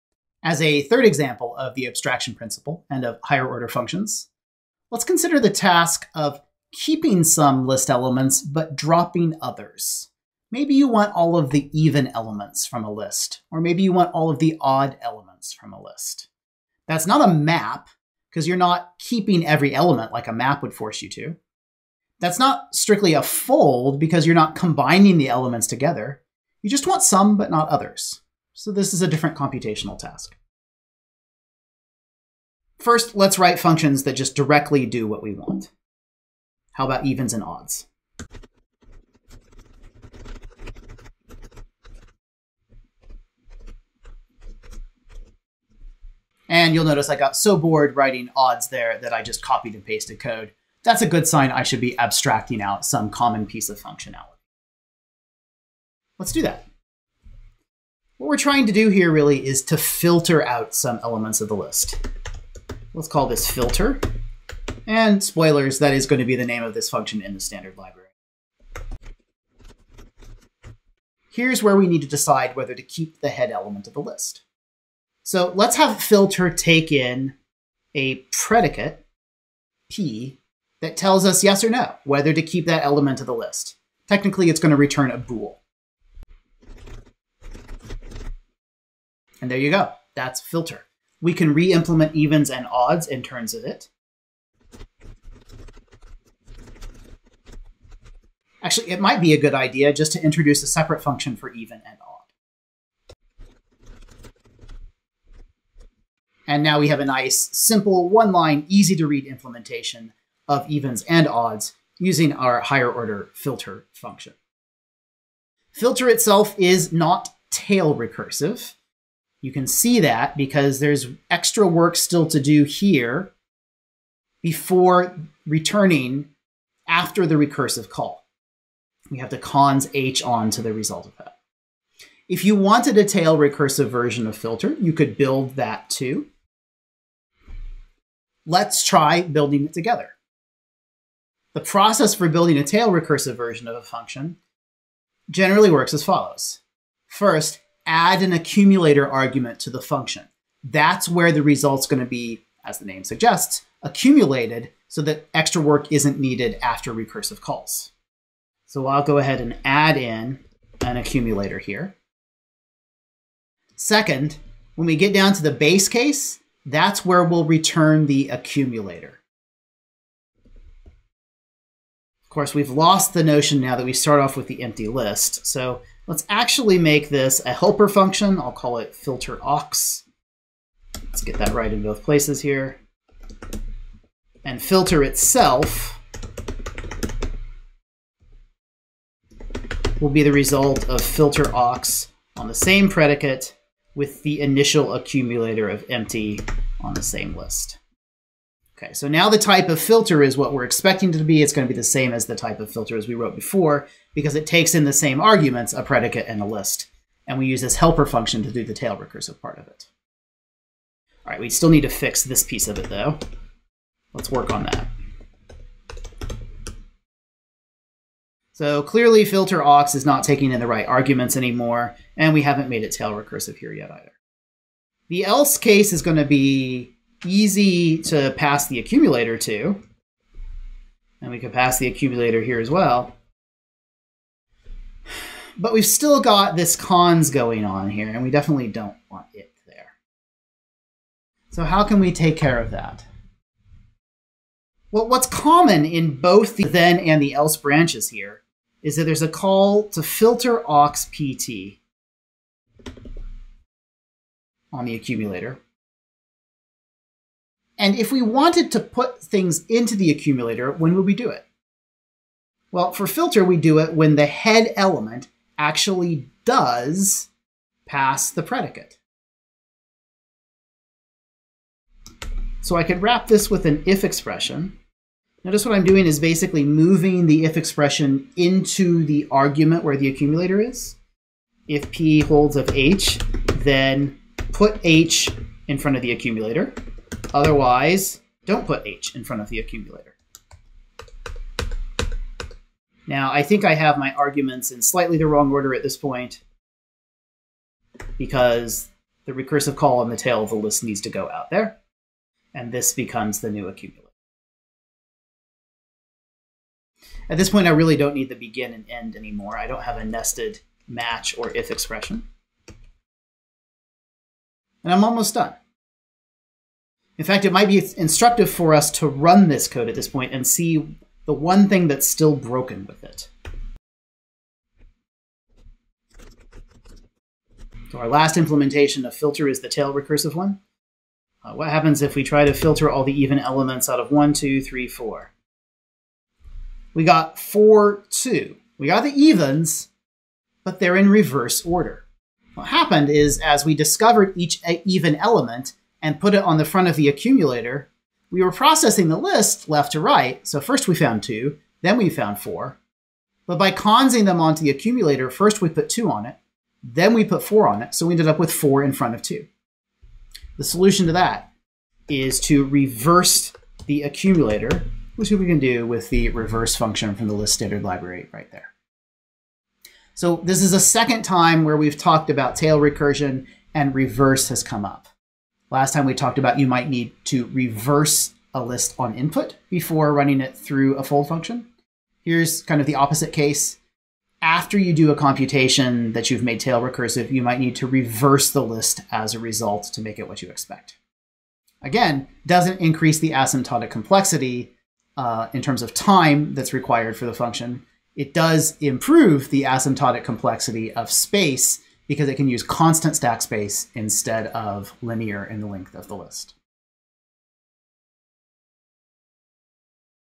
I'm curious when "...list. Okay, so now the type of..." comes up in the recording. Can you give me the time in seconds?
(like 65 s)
197 s.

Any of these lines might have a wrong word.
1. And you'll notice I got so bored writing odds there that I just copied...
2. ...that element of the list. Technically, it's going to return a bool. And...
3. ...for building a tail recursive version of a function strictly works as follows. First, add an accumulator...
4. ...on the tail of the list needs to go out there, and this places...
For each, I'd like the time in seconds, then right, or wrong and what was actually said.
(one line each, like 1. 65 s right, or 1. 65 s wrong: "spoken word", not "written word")
1. 46 s right
2. 82 s right
3. 142 s wrong: "generally", not "strictly"
4. 299 s wrong: "becomes", not "places".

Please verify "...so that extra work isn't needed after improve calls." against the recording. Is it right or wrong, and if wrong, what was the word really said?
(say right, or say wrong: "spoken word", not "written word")
wrong: "recursive", not "improve".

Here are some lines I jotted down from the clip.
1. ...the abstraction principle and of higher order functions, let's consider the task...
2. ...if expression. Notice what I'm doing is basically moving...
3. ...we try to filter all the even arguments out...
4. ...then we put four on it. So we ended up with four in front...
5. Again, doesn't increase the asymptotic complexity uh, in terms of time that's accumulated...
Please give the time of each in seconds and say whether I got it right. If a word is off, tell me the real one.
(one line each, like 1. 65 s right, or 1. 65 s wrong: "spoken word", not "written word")
1. 1 s right
2. 273 s right
3. 332 s wrong: "elements", not "arguments"
4. 356 s right
5. 391 s wrong: "required", not "accumulated".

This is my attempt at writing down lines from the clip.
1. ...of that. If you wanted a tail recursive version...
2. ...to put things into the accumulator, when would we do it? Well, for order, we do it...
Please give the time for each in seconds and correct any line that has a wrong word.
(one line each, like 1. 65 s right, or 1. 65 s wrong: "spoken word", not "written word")
1. 131 s right
2. 258 s wrong: "filter", not "order".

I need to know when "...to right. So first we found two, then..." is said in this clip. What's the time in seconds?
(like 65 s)
349 s.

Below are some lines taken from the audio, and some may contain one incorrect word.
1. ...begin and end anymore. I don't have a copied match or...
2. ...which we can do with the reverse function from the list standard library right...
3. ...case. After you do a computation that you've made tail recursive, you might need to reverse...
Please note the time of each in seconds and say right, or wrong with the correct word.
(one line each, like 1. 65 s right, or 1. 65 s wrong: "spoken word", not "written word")
1. 308 s wrong: "nested", not "copied"
2. 365 s right
3. 383 s right.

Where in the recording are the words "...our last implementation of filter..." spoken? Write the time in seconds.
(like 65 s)
327 s.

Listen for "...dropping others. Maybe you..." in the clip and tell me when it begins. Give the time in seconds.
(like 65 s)
8 s.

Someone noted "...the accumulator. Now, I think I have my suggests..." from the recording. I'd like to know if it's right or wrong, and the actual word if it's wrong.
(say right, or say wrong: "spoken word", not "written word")
wrong: "arguments", not "suggests".